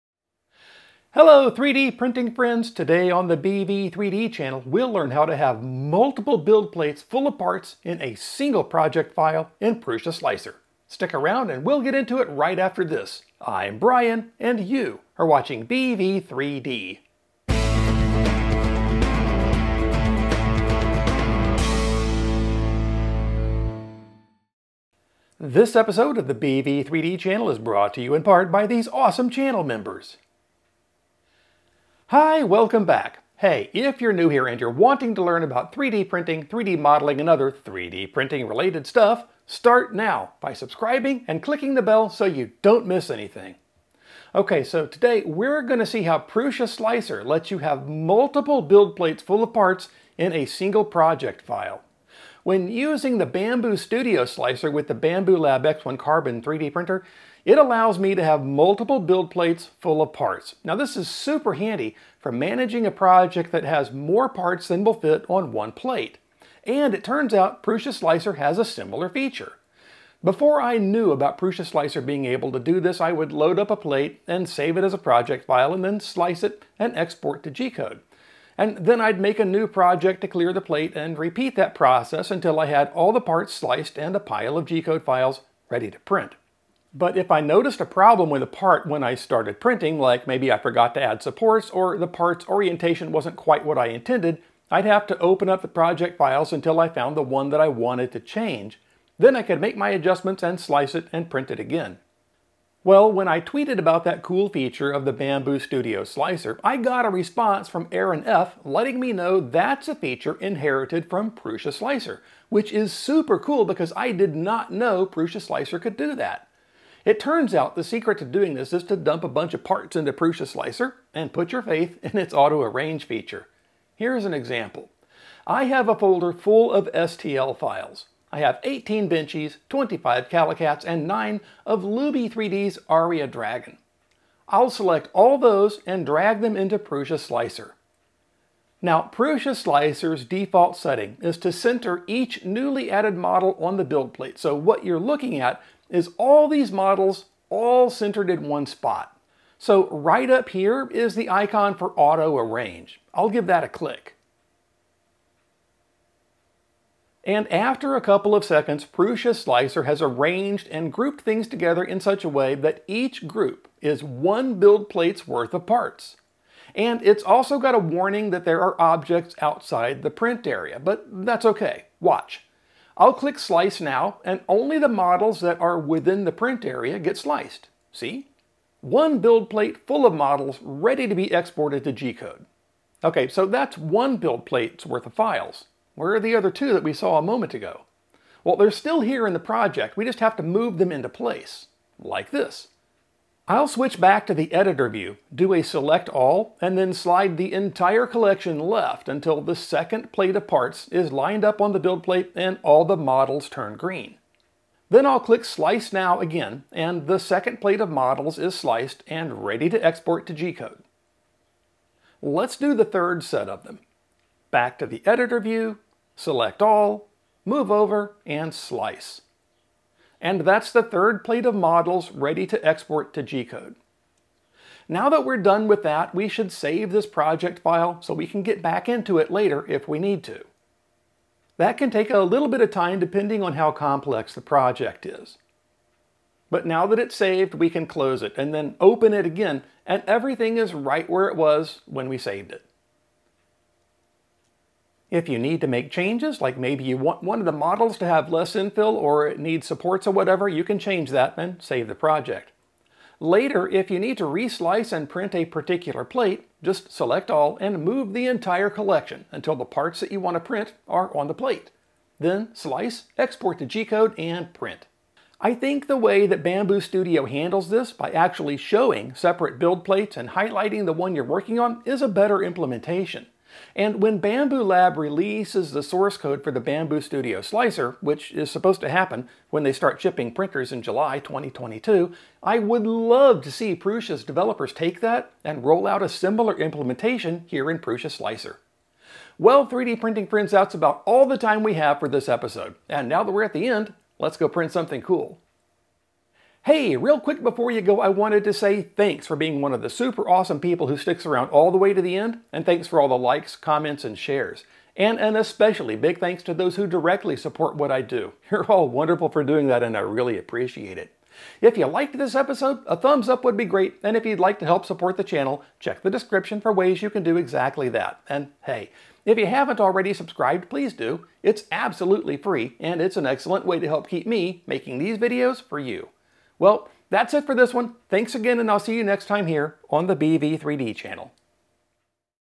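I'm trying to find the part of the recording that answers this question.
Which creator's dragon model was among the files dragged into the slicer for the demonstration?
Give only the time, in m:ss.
2:11.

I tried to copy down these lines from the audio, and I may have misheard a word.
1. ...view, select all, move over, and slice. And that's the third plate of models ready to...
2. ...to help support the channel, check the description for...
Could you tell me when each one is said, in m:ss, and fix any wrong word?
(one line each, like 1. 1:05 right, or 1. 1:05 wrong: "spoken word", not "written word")
1. 3:35 right
2. 5:14 right.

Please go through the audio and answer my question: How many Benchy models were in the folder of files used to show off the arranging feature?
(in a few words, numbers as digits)
18.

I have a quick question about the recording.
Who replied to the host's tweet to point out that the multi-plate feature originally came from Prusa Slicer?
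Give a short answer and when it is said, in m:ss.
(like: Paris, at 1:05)
Aaron F., at 1:47.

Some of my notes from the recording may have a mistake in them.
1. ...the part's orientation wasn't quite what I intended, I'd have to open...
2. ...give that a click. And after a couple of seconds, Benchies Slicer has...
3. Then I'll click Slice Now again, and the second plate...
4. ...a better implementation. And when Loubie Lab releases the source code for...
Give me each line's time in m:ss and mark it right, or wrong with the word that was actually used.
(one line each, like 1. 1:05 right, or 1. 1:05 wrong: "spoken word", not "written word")
1. 1:31 right
2. 2:33 wrong: "Prusa", not "Benchies"
3. 3:24 right
4. 4:32 wrong: "Bambu", not "Loubie".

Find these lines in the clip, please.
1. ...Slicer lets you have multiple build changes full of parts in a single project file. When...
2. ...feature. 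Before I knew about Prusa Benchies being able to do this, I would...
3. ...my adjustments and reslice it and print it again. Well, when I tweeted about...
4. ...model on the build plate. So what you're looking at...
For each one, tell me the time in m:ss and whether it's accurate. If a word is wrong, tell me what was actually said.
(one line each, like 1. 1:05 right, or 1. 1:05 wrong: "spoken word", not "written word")
1. 0:46 wrong: "plates", not "changes"
2. 1:09 wrong: "Slicer", not "Benchies"
3. 1:39 wrong: "slice", not "reslice"
4. 2:23 right.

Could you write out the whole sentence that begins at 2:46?
And it's also got a warning that there are objects outside the print area, but that's okay.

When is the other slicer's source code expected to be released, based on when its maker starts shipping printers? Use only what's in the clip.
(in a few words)
July 2022.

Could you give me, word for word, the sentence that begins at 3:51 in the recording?
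That can take a little bit of time depending on how complex the project is.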